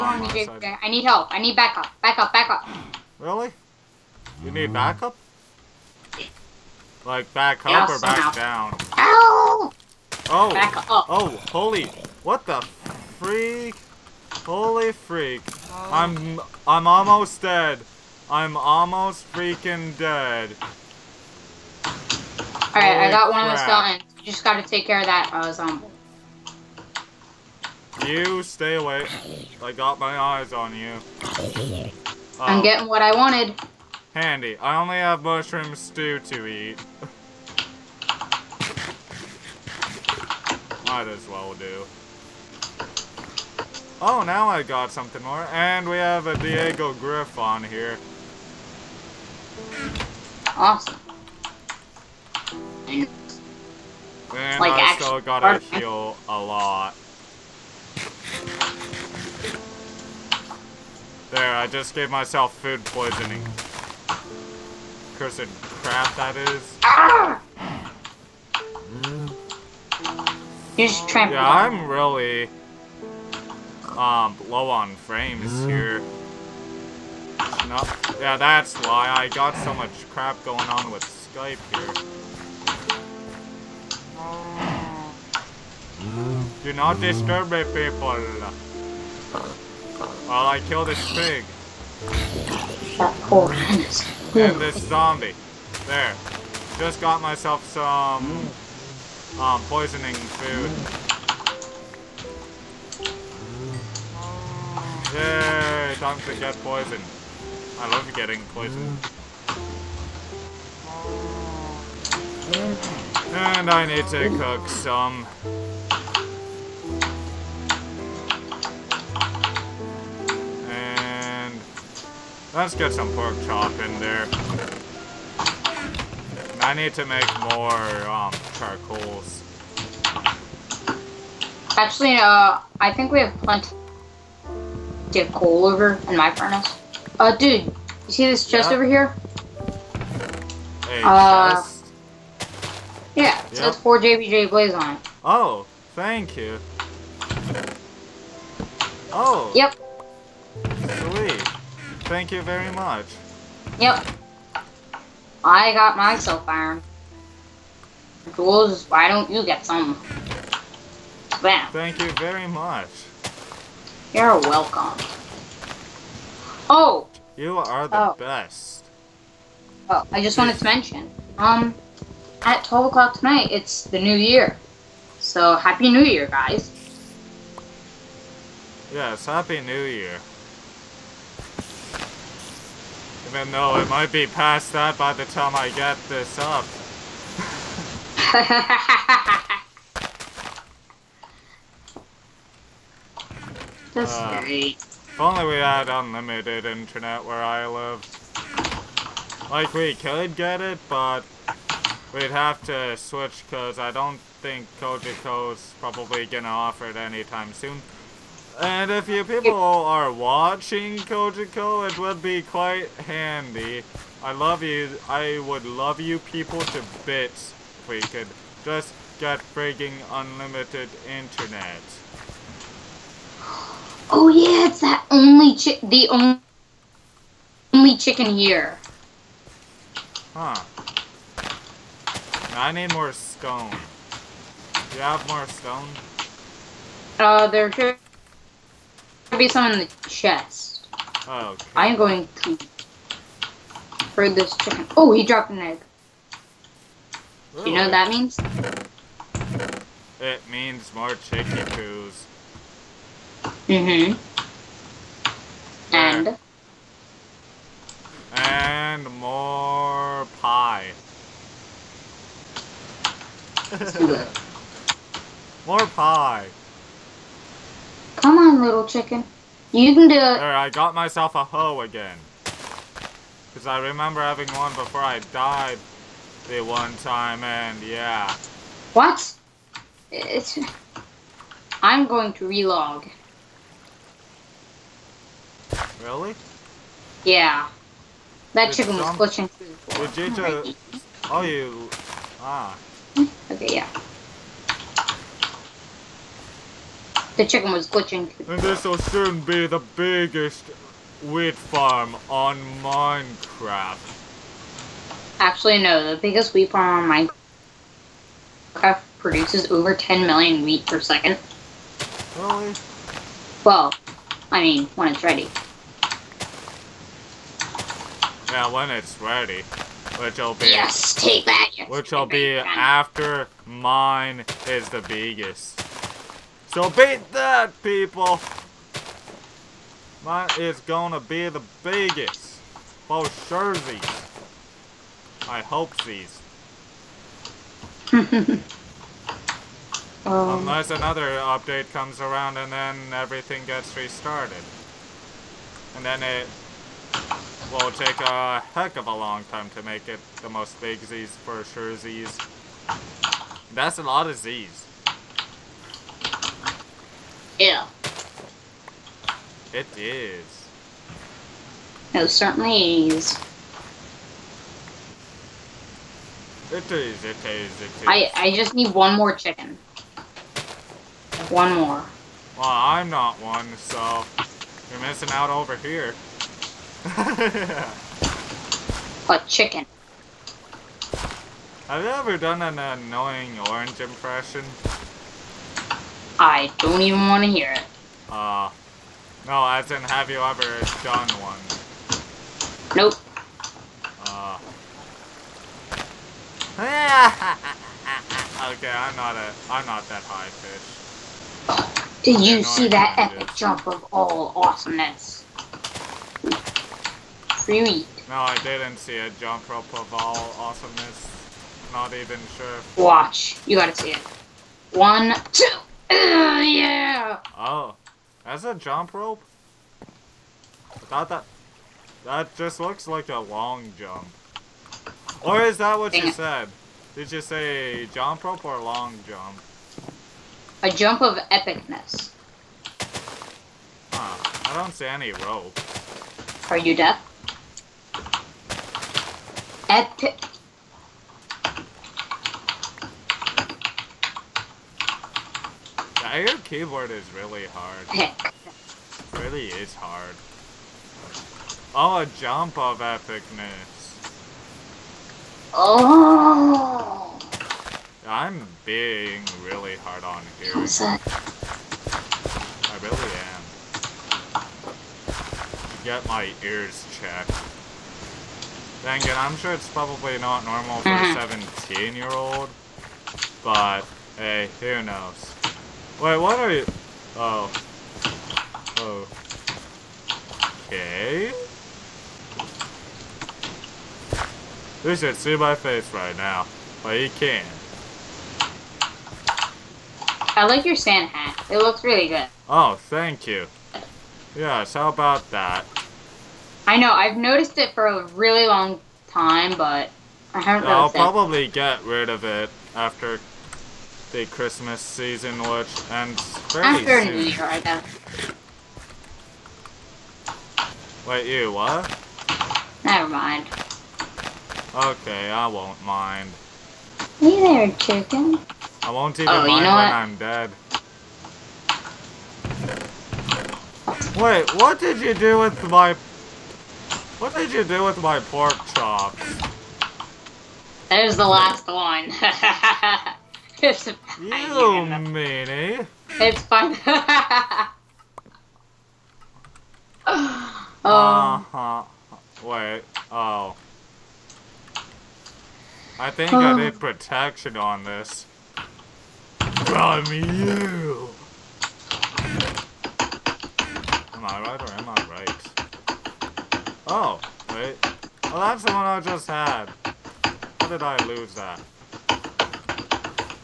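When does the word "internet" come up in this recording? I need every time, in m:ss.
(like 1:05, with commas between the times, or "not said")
3:16, 3:41.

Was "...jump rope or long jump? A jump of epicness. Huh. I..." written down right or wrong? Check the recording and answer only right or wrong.
right.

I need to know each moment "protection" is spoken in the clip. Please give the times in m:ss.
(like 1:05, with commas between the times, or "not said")
9:06.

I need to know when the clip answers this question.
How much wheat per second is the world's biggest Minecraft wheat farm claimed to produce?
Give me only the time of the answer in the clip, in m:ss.
5:09.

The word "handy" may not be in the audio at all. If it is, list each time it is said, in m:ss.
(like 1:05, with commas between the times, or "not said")
0:34, 3:33.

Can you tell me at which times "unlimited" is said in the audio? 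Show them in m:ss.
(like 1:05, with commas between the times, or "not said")
3:15, 3:40.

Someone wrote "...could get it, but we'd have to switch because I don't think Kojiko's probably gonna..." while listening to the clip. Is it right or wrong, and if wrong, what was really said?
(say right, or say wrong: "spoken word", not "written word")
right.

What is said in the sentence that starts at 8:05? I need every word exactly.
You should see my face right now.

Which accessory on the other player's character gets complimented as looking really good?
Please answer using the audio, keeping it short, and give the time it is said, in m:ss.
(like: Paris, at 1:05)
Sand hat, at 8:10.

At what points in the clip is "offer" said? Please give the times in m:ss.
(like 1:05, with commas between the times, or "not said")
3:26.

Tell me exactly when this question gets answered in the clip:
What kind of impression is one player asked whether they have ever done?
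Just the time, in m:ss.
6:22.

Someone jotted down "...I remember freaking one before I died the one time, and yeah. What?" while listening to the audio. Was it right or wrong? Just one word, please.
wrong.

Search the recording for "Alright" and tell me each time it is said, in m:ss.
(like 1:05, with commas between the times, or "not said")
0:22.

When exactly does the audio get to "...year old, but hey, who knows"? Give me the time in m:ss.
7:52.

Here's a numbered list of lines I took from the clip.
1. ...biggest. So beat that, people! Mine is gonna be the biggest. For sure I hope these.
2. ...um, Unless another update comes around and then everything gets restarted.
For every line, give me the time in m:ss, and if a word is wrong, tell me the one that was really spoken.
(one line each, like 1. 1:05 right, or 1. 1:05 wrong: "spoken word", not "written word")
1. 5:25 right
2. 5:40 right.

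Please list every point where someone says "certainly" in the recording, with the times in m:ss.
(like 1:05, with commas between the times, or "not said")
6:02.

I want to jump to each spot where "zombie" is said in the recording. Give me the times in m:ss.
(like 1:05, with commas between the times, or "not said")
0:25, 1:34.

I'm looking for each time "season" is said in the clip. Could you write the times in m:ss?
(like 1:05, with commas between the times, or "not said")
8:24.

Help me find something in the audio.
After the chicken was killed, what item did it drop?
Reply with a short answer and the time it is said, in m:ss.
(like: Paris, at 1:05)
An egg, at 4:05.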